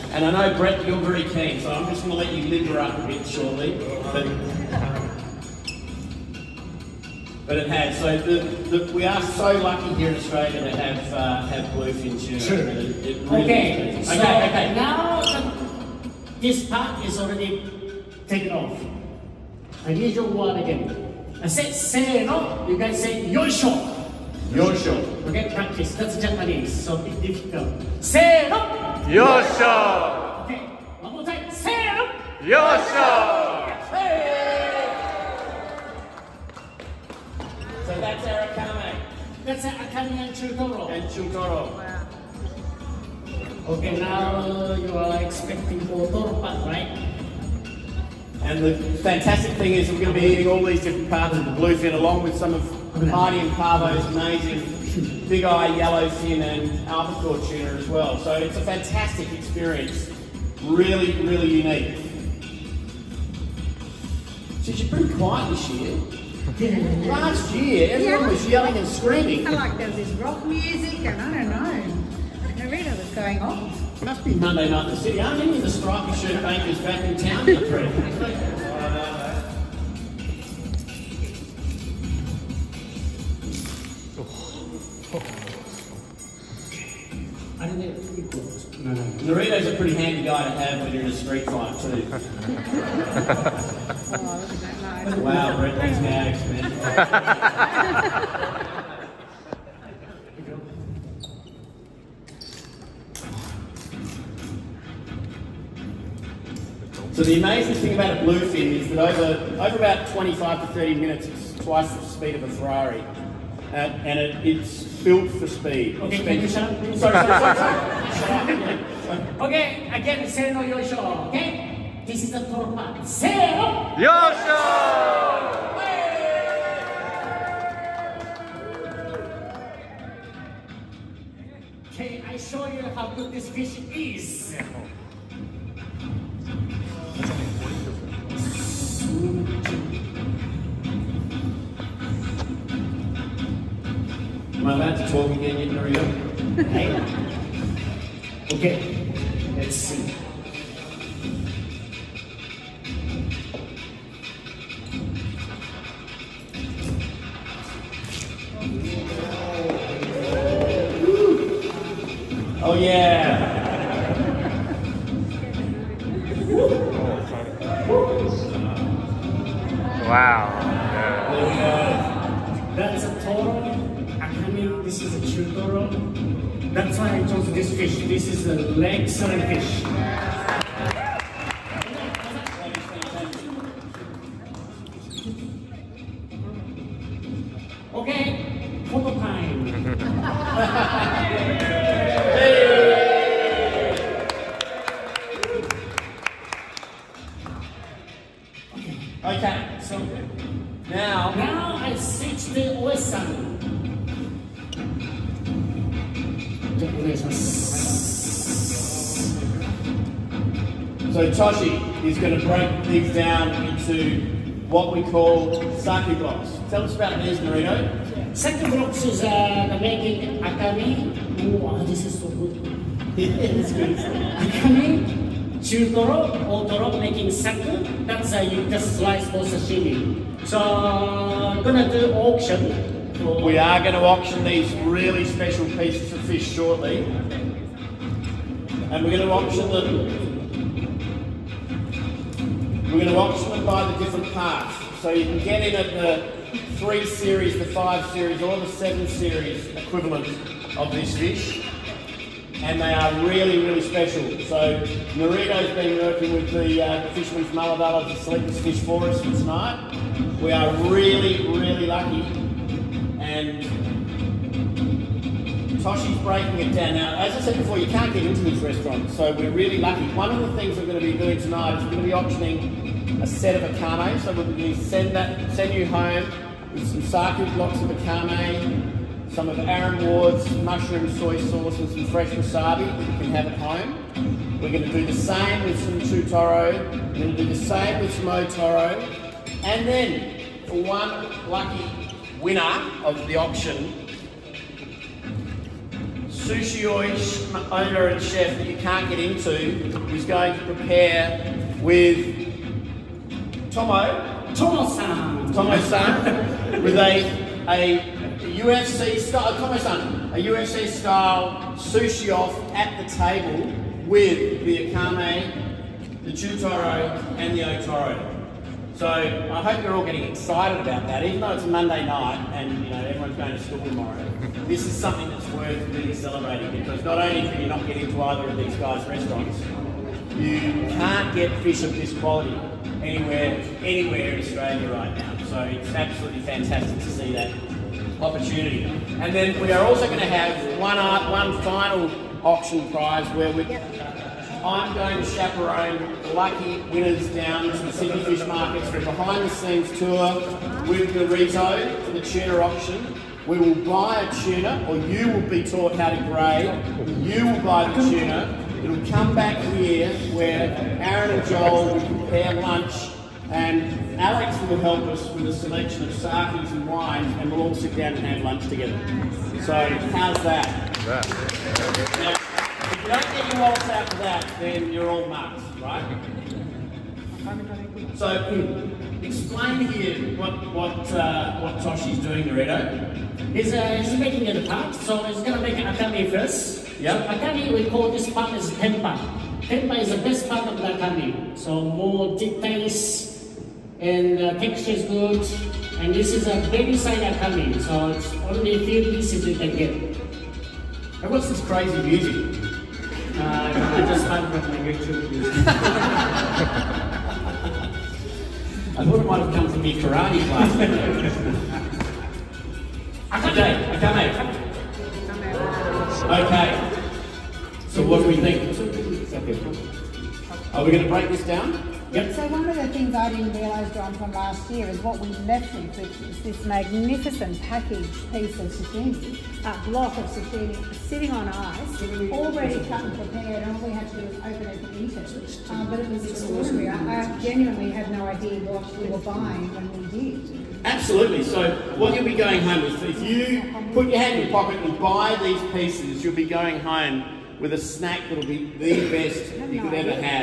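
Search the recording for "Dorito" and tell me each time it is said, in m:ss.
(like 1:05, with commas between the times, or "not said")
3:37, 5:51, 6:22.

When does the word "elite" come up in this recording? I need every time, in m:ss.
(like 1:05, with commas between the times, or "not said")
not said.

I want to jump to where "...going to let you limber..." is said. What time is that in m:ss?
0:02.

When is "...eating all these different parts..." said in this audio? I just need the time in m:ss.
0:50.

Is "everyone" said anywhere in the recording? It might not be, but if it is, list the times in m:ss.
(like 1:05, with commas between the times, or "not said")
1:07, 5:23.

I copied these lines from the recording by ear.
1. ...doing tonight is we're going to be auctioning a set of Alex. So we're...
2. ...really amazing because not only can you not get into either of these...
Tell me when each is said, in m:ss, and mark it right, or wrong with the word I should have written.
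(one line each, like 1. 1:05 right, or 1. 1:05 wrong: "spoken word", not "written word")
1. 4:31 wrong: "Akami", not "Alex"
2. 5:25 wrong: "celebrating", not "amazing".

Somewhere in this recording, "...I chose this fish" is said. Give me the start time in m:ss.
2:57.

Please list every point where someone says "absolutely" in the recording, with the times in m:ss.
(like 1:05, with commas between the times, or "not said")
5:35, 7:20.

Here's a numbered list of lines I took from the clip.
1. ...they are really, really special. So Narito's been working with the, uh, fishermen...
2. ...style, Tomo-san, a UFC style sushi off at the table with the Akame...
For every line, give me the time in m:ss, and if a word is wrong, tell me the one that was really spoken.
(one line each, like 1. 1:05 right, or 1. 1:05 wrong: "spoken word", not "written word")
1. 4:12 right
2. 5:09 right.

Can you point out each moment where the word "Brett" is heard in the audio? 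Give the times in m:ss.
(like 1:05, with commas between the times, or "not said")
0:00, 1:35.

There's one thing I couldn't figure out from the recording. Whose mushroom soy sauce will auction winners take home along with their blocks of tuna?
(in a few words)
Aaron Ward.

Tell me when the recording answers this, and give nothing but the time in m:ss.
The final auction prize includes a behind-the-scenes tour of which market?
5:47.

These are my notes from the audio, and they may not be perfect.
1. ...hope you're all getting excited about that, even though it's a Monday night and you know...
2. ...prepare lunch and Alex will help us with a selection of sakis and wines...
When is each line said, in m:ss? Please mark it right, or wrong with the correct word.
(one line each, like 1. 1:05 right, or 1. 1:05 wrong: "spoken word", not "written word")
1. 5:19 right
2. 6:02 right.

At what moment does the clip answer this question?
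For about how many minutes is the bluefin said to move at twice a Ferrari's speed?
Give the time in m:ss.
1:50.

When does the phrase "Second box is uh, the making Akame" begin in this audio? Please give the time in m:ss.
3:38.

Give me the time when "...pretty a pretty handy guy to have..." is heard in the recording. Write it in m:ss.
1:29.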